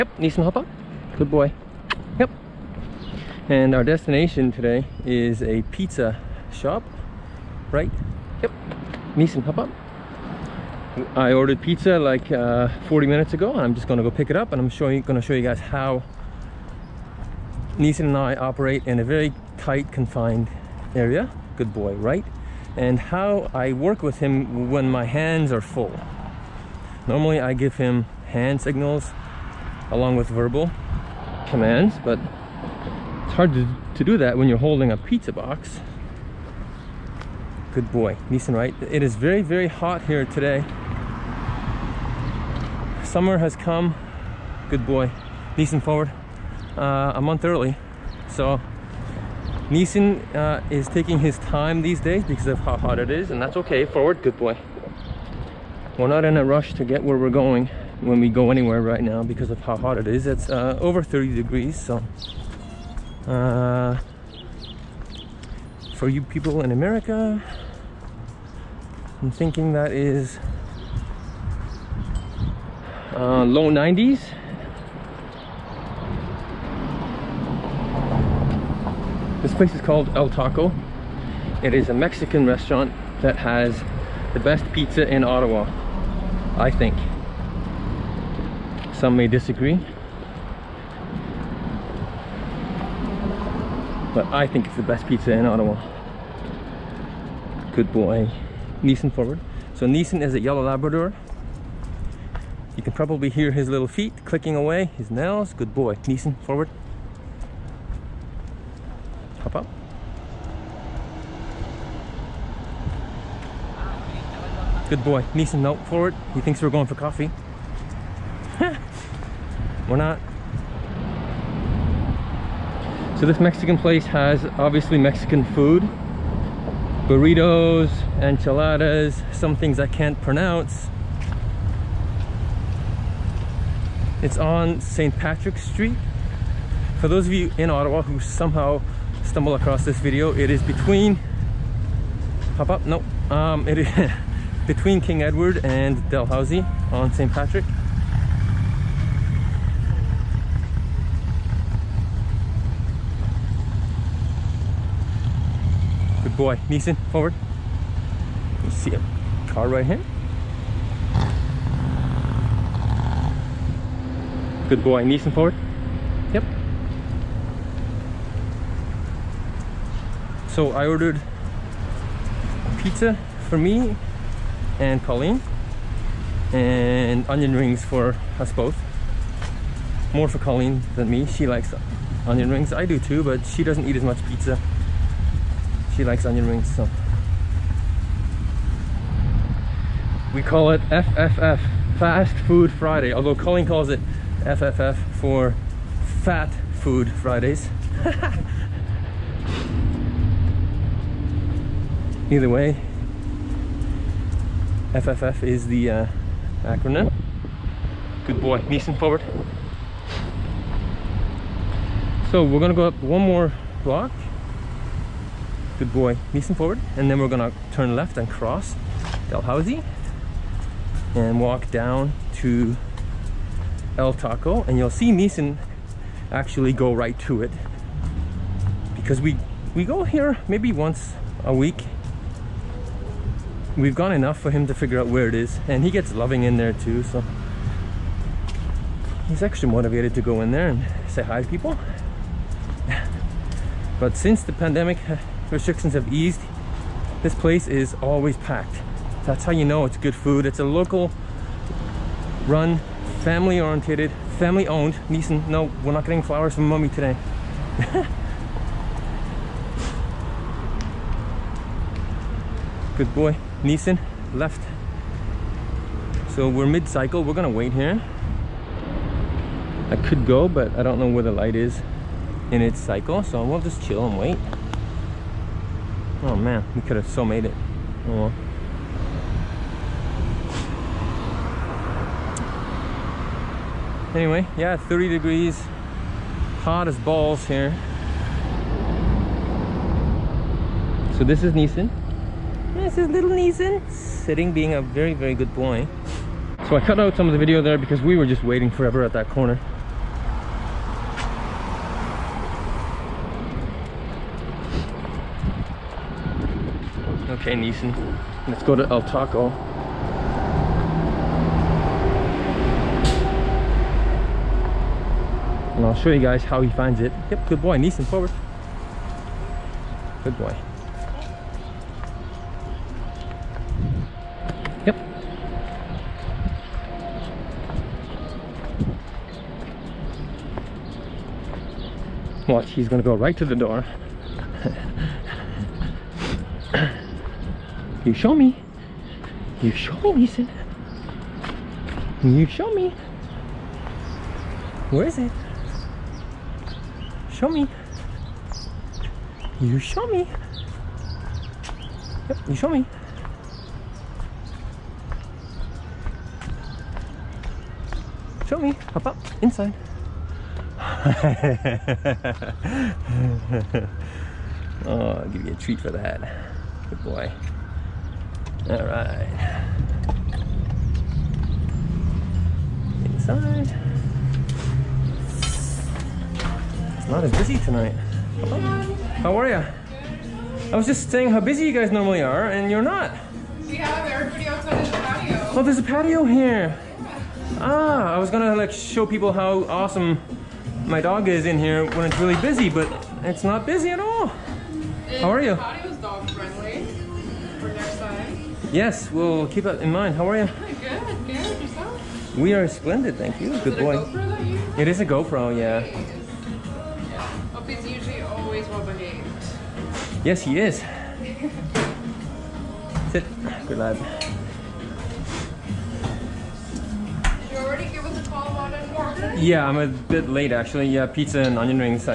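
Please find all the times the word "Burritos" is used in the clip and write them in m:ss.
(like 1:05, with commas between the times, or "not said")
2:07.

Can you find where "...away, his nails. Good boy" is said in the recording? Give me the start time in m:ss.
1:44.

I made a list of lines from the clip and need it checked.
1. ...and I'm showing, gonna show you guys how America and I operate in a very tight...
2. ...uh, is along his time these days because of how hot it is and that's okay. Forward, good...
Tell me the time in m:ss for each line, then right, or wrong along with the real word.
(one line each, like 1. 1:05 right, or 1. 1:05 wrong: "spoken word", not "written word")
1. 0:14 wrong: "Neeson", not "America"
2. 0:50 wrong: "taking", not "along".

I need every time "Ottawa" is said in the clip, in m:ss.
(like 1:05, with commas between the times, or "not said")
1:25, 1:35, 2:17.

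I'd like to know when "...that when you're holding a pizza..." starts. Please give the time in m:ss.
0:34.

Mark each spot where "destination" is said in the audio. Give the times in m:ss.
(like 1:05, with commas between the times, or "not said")
0:03.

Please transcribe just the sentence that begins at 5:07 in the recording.
Okay, Neeson, let's go to El Taco.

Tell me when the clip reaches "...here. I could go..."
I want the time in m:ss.
4:27.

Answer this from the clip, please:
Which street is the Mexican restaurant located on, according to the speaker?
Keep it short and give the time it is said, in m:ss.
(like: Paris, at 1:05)
St. Patrick Street, at 2:14.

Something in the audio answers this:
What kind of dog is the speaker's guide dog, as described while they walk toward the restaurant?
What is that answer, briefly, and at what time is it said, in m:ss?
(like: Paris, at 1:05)
Yellow Labrador, at 1:40.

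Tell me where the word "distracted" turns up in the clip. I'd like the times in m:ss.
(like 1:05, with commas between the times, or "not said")
not said.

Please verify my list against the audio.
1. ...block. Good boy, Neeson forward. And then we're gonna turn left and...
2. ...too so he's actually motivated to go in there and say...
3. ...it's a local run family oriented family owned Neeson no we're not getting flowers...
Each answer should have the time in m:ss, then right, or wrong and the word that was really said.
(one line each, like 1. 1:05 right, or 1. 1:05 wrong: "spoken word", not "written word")
1. 3:33 right
2. 3:56 right
3. 4:10 right.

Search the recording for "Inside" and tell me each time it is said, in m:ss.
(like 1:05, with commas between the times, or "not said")
5:59, 6:13.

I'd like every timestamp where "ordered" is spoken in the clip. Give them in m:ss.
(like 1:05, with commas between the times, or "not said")
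0:11, 2:50.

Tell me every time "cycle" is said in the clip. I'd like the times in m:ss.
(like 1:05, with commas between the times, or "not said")
4:26, 4:32.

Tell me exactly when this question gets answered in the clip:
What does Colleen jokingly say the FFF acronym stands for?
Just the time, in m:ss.
3:16.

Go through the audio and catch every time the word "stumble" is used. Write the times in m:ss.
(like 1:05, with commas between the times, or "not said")
2:19.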